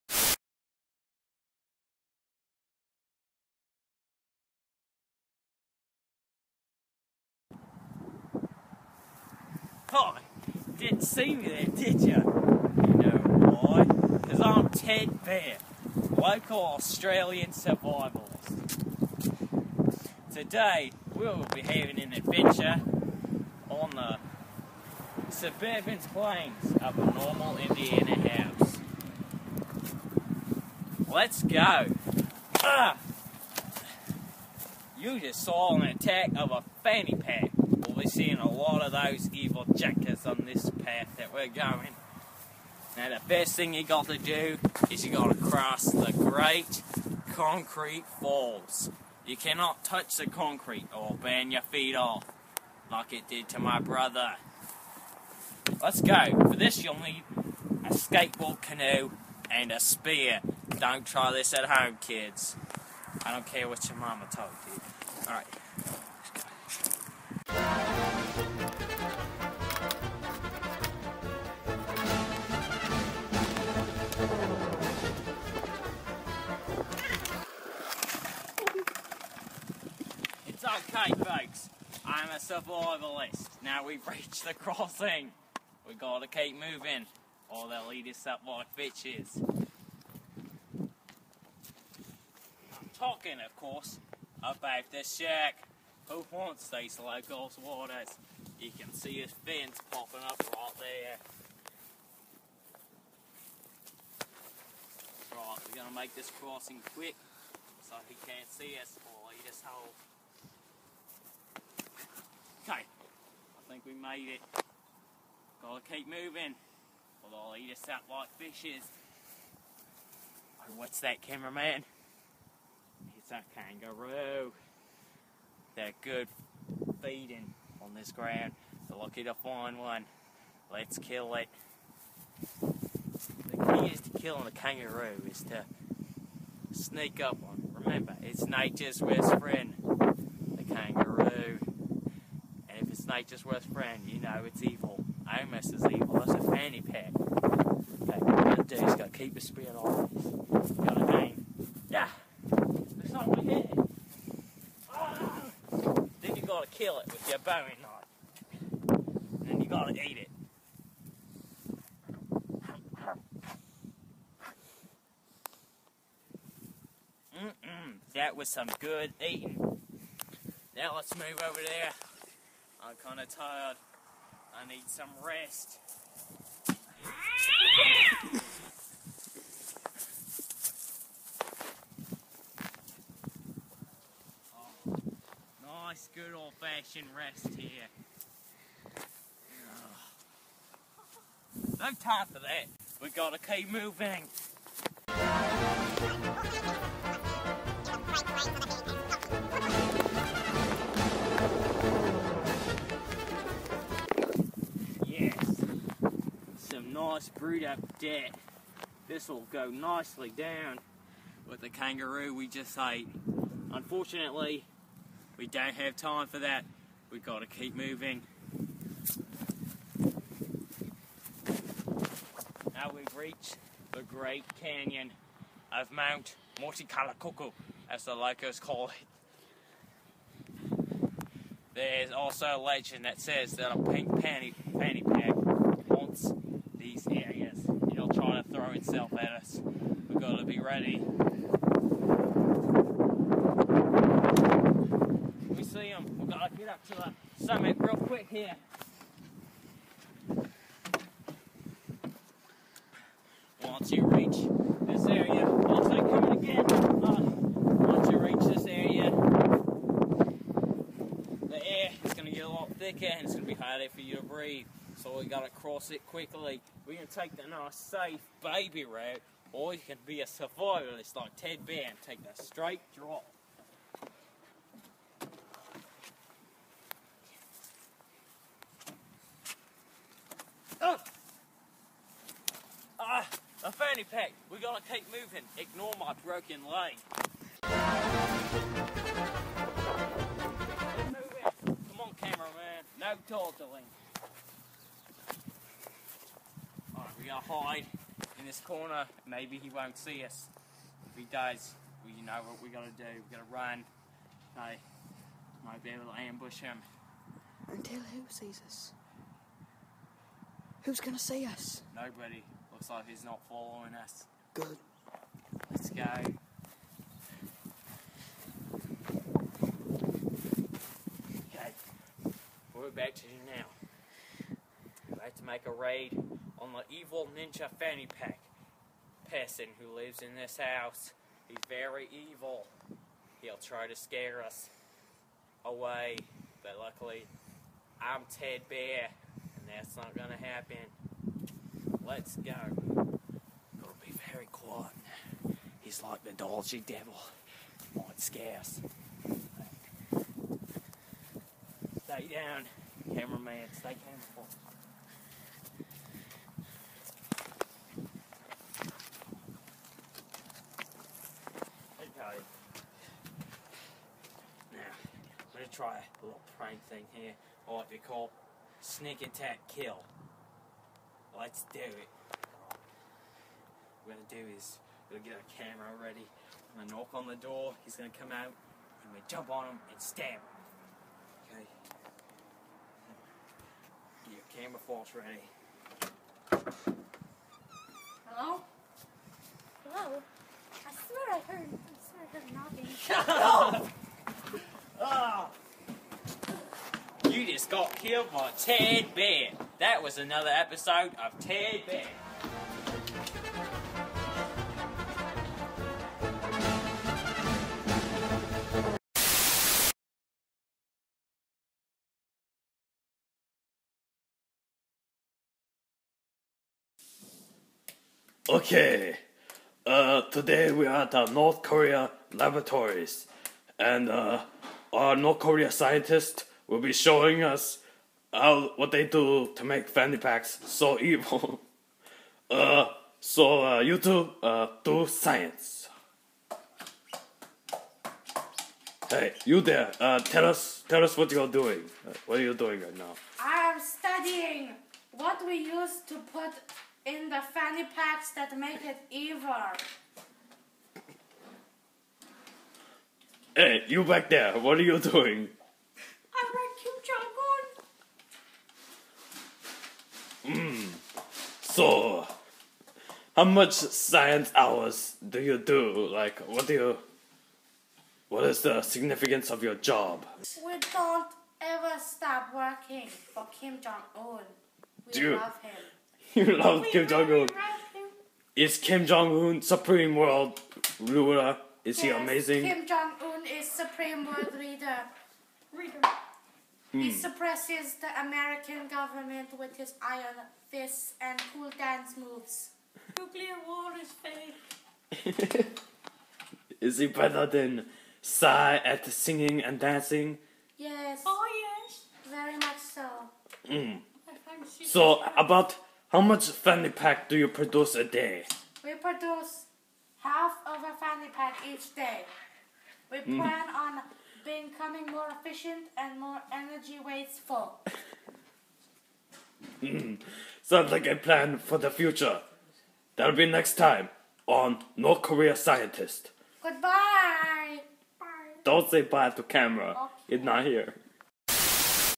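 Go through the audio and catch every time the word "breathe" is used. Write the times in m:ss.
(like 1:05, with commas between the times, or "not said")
4:24.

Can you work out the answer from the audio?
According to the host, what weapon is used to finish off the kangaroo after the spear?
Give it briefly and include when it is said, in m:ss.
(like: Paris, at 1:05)
bowie knife, at 2:37.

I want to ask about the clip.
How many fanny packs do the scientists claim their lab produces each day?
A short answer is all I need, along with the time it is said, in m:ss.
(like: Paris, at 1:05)
half of a fanny pack, at 8:30.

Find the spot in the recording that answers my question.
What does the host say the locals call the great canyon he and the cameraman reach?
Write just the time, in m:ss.
3:45.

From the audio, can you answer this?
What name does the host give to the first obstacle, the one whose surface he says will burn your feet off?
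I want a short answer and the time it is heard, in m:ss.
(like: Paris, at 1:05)
the great concrete falls, at 0:46.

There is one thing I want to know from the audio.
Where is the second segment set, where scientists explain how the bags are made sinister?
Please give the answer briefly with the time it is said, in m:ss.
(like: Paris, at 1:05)
North Korea laboratories, at 7:01.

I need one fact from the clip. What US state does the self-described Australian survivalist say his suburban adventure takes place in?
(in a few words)
Indiana.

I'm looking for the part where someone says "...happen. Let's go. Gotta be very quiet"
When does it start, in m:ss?
5:40.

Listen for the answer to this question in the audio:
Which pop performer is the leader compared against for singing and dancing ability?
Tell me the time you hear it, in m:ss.
8:18.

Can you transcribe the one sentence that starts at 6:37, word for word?
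You just got killed by Ted Bear.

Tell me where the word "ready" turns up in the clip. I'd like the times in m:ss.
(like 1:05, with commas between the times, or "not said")
4:00, 6:16, 6:25.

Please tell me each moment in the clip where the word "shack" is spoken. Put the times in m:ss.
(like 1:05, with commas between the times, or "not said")
1:35.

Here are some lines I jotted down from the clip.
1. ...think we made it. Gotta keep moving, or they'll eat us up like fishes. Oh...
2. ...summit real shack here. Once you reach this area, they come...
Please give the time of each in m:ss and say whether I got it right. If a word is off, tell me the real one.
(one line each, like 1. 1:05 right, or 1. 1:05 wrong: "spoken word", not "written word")
1. 1:53 right
2. 4:07 wrong: "quick", not "shack".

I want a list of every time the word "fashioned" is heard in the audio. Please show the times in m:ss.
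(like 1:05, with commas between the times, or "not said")
3:06.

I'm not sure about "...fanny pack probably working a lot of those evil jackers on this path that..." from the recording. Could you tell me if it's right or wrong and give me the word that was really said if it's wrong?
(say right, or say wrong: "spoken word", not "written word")
wrong: "seeing", not "working".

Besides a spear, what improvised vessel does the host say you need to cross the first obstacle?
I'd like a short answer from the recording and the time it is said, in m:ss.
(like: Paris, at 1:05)
skateboard canoe, at 0:57.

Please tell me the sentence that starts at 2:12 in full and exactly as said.
The key is to killing a kangaroo is to sneak up on.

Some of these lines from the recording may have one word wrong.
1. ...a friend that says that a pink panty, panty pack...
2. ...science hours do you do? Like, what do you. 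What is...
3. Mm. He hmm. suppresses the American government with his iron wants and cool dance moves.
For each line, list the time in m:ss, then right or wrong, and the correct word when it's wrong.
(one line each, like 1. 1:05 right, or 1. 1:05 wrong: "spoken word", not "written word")
1. 3:52 wrong: "legend", not "friend"
2. 7:43 right
3. 8:06 wrong: "fists", not "wants".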